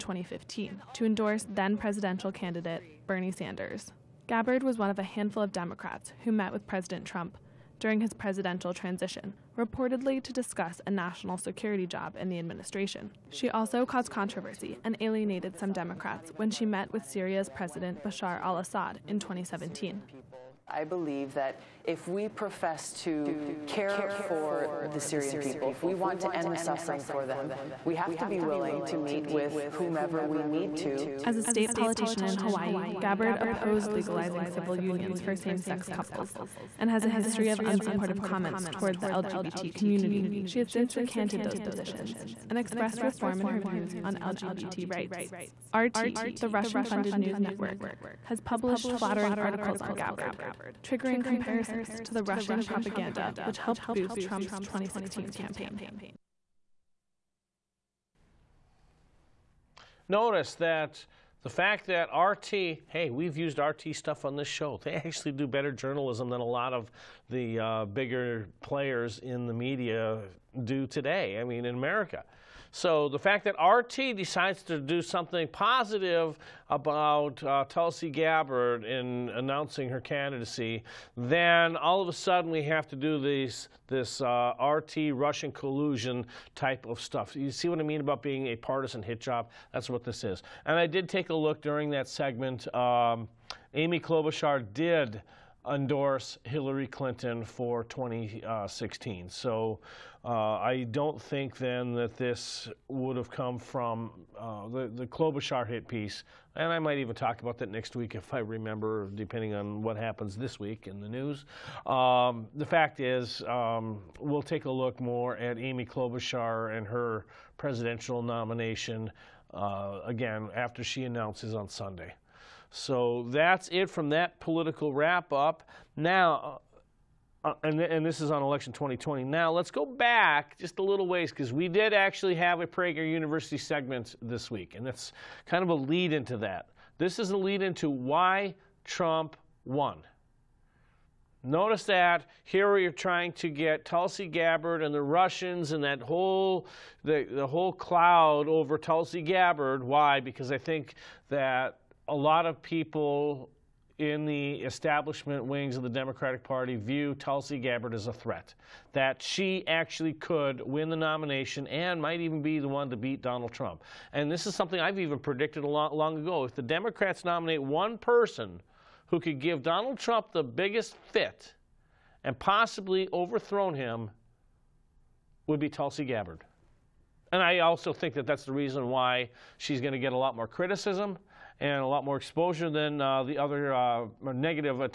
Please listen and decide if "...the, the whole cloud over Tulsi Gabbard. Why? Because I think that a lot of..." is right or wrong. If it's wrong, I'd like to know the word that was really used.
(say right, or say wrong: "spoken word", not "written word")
right.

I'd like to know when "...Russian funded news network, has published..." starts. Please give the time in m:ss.
0:46.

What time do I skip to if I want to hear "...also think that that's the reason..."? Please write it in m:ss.
2:57.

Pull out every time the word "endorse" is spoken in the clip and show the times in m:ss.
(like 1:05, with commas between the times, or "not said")
0:01, 1:35.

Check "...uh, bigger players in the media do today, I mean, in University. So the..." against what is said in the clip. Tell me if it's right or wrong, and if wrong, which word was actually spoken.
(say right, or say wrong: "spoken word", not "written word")
wrong: "America", not "University".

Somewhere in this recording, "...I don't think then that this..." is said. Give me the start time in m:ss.
1:40.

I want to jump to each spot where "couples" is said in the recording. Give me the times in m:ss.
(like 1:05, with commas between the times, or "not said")
0:35.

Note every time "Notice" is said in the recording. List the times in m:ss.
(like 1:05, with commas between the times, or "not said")
1:00, 2:21.